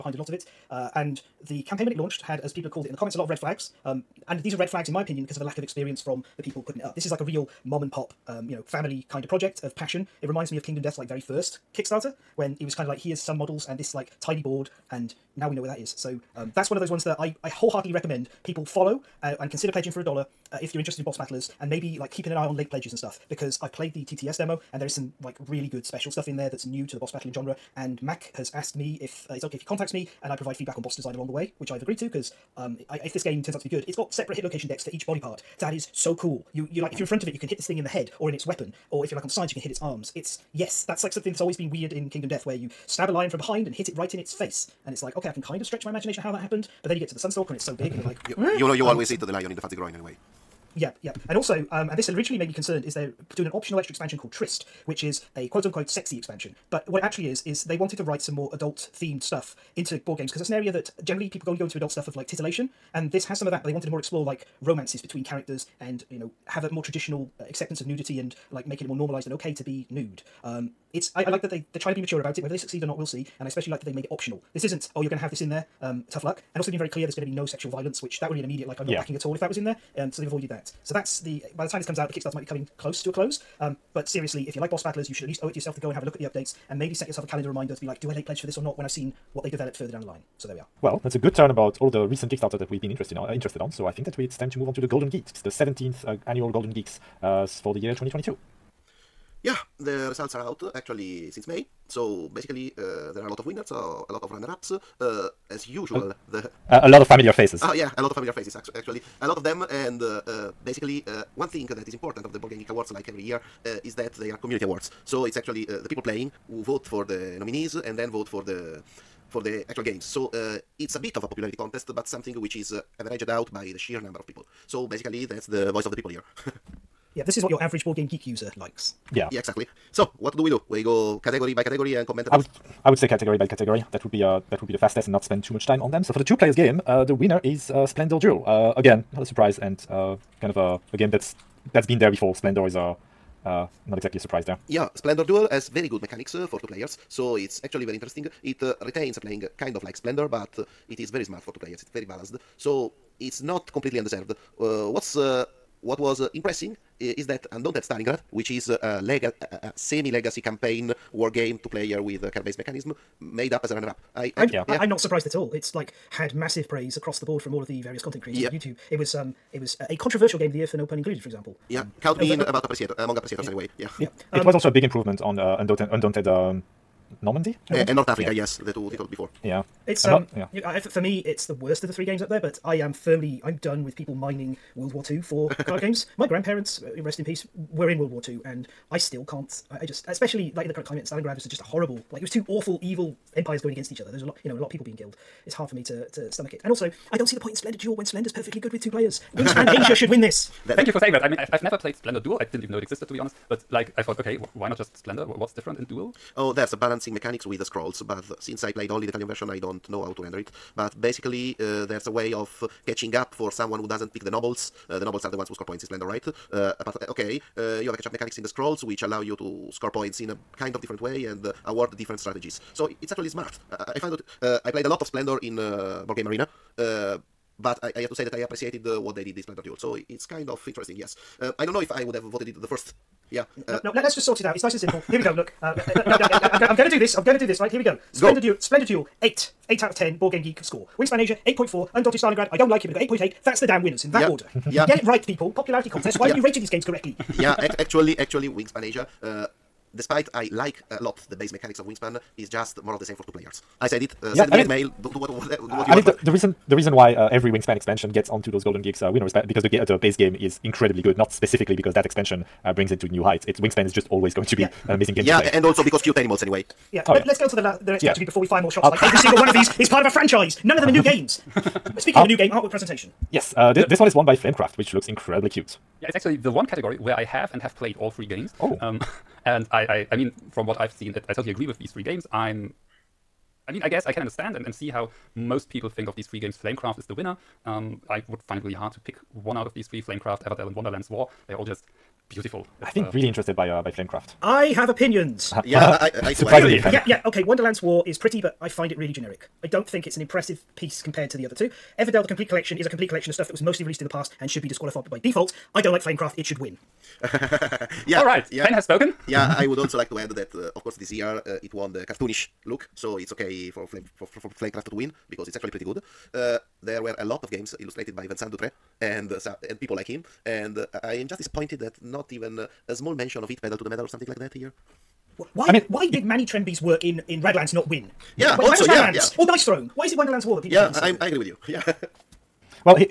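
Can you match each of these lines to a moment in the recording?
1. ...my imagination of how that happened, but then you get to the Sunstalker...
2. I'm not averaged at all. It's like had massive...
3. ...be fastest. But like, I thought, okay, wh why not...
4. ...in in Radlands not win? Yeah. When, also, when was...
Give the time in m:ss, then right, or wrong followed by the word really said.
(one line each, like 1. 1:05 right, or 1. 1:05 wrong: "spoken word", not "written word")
1. 0:45 right
2. 2:44 wrong: "surprised", not "averaged"
3. 3:23 wrong: "honest", not "fastest"
4. 5:27 right.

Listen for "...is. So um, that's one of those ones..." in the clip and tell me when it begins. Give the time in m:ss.
0:15.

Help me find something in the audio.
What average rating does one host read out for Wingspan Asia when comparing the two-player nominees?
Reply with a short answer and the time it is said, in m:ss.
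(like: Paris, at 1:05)
8.4, at 4:01.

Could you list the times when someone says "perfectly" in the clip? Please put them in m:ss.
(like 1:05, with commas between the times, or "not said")
3:18.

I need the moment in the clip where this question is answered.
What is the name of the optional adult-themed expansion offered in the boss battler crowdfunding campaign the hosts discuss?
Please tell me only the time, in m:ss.
0:54.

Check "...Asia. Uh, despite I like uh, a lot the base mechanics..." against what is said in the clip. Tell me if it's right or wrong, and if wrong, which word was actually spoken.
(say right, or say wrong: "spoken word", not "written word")
right.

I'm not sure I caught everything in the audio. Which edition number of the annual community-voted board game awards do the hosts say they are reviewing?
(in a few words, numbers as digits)
17th.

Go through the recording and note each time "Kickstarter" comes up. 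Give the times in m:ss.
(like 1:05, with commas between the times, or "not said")
0:11, 1:22, 1:32.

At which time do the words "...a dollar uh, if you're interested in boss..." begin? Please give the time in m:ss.
0:20.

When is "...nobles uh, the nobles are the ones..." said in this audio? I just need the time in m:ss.
3:34.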